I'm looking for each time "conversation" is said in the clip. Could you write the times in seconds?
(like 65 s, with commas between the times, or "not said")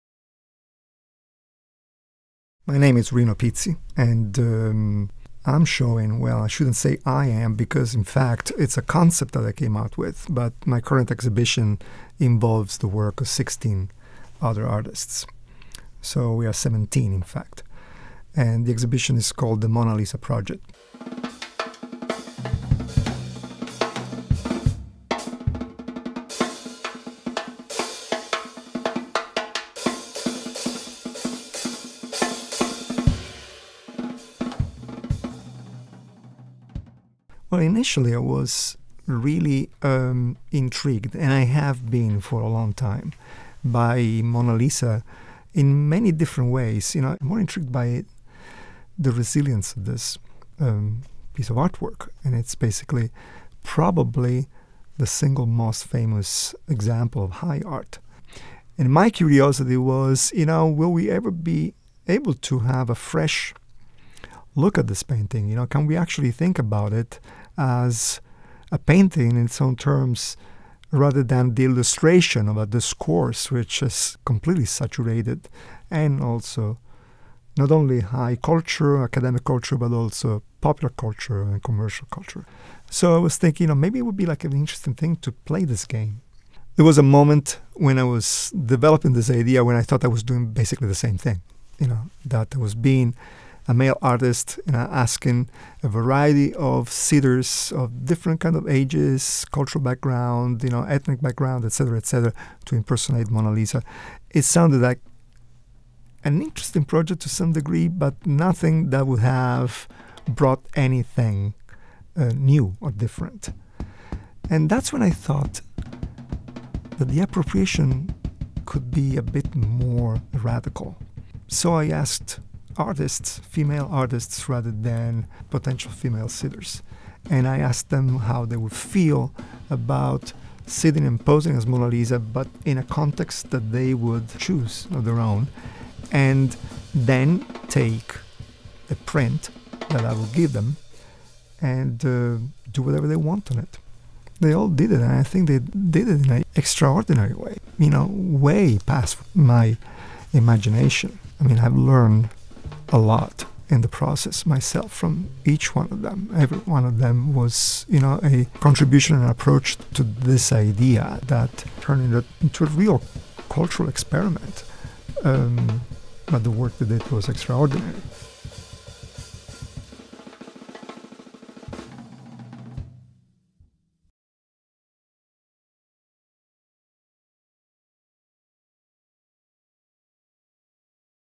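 not said.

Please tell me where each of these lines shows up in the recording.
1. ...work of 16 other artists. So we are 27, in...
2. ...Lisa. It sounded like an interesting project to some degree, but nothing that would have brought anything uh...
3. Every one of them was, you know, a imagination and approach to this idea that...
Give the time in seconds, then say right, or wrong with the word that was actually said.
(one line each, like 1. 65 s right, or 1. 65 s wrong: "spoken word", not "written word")
1. 12 s wrong: "17", not "27"
2. 103 s right
3. 156 s wrong: "contribution", not "imagination".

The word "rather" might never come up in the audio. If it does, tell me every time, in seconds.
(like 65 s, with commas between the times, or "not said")
70 s, 124 s.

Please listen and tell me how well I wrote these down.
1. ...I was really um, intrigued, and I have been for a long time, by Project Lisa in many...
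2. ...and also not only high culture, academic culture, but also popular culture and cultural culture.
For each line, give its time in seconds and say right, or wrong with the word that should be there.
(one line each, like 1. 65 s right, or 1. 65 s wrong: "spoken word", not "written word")
1. 38 s wrong: "Mona", not "Project"
2. 75 s wrong: "commercial", not "cultural".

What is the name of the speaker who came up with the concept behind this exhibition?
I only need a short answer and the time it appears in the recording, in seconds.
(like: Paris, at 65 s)
Rino Pizzi, at 3 s.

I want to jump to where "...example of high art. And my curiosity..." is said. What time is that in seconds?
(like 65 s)
56 s.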